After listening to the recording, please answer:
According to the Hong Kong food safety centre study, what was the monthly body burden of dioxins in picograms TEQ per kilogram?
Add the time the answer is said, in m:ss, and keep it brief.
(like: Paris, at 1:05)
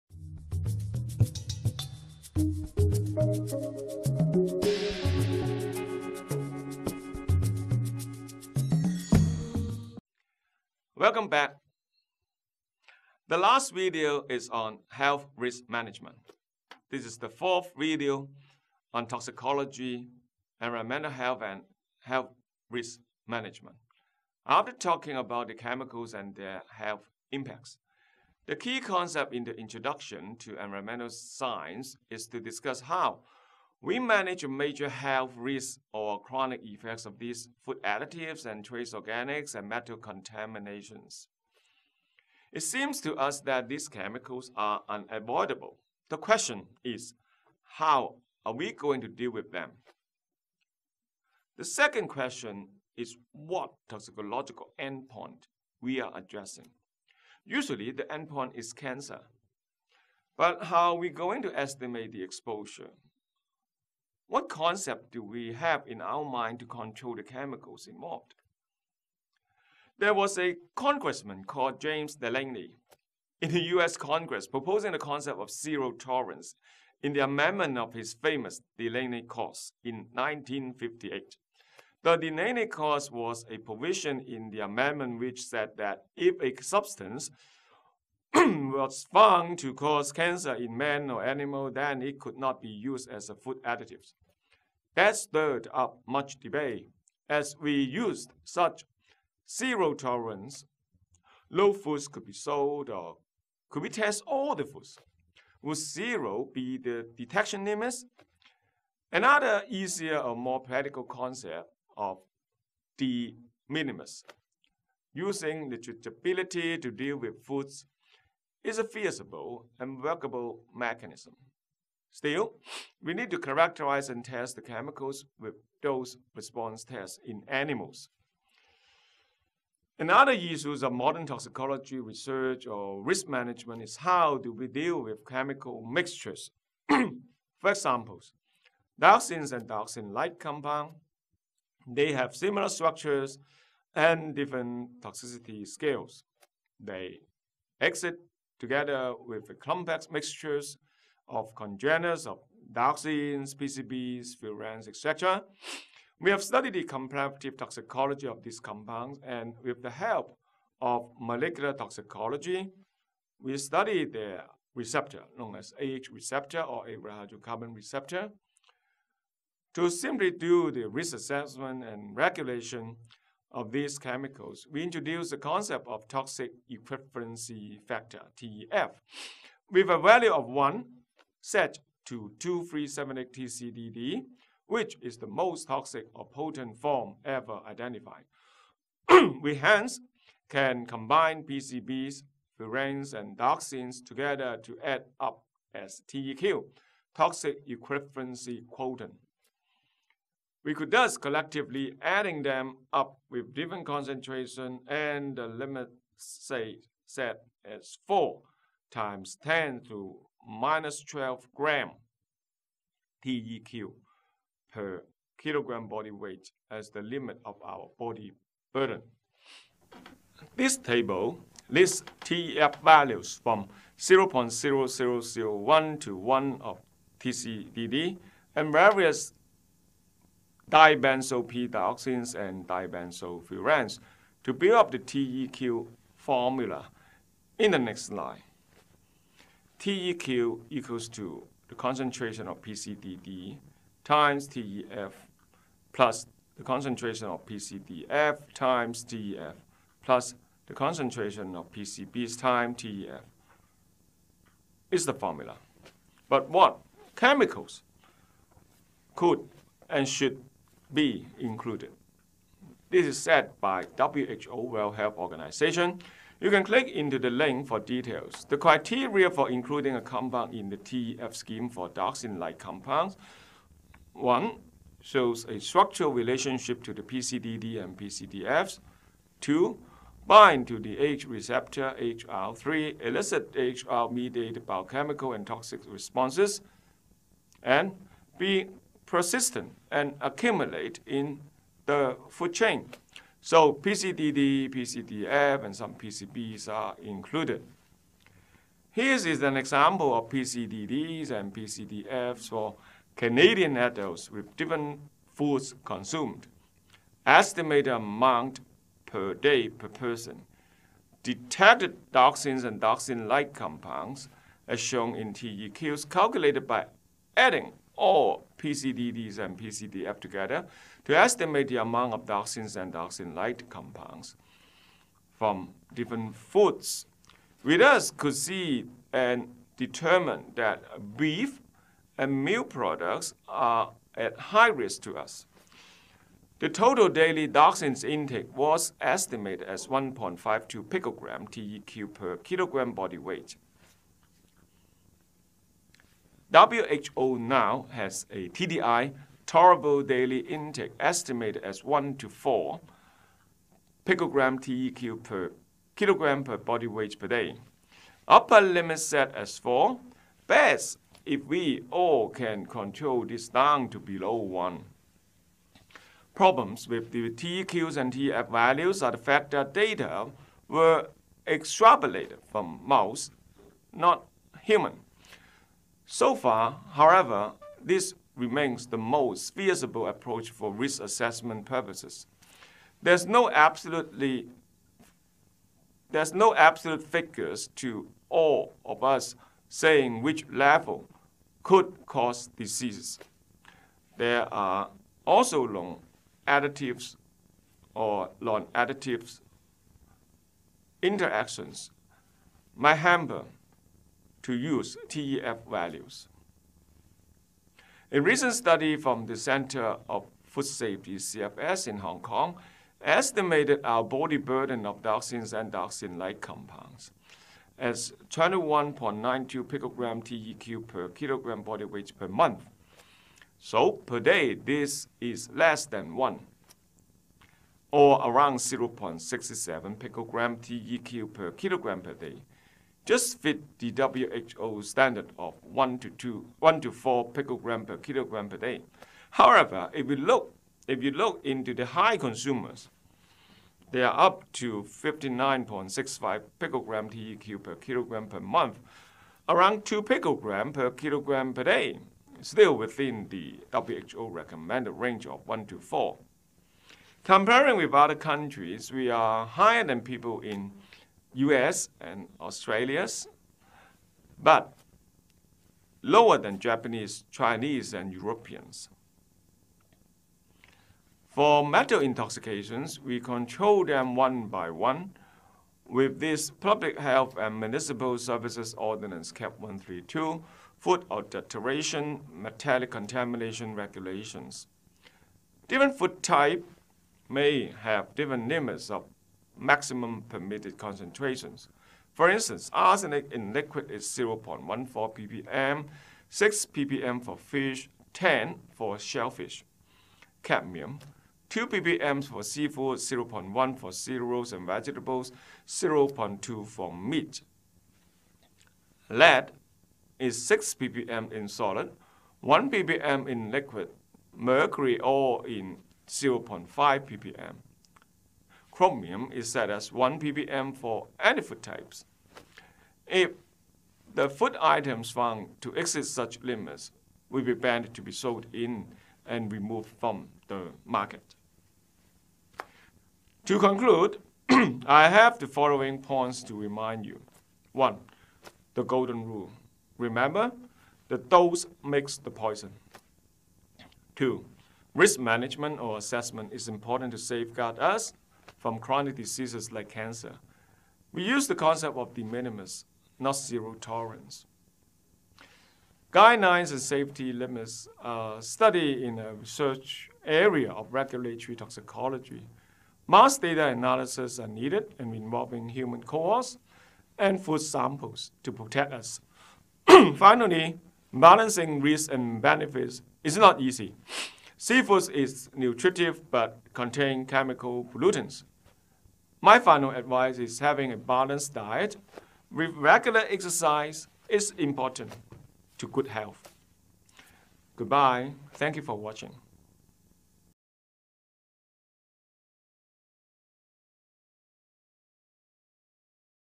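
21.92, at 6:58.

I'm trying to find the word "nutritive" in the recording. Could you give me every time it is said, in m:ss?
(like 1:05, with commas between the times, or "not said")
9:35.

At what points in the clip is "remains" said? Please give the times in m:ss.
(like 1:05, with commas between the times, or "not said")
6:18.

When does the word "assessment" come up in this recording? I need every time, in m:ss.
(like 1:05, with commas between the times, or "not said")
2:51, 6:21, 9:05.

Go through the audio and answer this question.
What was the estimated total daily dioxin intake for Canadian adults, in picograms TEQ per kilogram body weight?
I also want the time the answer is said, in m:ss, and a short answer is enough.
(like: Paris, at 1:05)
1.52, at 5:39.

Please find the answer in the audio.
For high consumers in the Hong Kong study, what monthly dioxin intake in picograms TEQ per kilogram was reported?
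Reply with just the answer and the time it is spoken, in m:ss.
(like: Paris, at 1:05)
59.65, at 7:24.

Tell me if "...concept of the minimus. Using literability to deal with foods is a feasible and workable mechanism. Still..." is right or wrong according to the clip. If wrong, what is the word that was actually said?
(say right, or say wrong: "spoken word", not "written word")
right.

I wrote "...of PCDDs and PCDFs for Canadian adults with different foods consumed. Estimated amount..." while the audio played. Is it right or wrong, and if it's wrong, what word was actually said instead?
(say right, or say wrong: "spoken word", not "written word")
right.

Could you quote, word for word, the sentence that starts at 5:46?
WHO now has a TDI, tolerable daily intake, estimated as 1 to 4 picogram TEQ per kilogram per body weight per day.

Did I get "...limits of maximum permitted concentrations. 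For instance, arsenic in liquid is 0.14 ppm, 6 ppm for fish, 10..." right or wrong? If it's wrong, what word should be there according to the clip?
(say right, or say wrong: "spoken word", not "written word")
right.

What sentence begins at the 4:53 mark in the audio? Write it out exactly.
So PCDD, PCDF, and some PCBs are included.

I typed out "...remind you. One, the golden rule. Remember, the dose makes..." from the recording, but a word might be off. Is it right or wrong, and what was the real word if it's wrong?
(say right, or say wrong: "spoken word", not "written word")
right.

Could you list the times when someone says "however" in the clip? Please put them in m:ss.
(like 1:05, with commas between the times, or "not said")
6:16, 7:19.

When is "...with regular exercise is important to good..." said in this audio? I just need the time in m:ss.
9:42.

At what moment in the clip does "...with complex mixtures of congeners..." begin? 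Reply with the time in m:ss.
2:29.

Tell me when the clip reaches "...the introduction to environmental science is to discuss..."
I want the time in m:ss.
0:29.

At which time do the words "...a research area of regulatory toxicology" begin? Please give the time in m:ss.
9:19.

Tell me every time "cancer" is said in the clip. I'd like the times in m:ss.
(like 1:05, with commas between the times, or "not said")
0:58, 1:30, 9:09.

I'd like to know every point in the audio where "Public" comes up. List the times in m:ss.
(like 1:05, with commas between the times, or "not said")
7:56.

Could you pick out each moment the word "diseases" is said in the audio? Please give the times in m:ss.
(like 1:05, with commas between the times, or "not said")
6:32, 9:09.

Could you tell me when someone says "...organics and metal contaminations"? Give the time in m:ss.
0:38.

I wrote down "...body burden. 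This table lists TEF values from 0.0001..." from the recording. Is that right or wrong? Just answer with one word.
right.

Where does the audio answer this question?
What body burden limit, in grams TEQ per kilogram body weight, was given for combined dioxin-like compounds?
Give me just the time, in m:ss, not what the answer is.
3:28.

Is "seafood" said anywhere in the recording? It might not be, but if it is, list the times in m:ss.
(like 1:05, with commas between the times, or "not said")
8:22, 9:34.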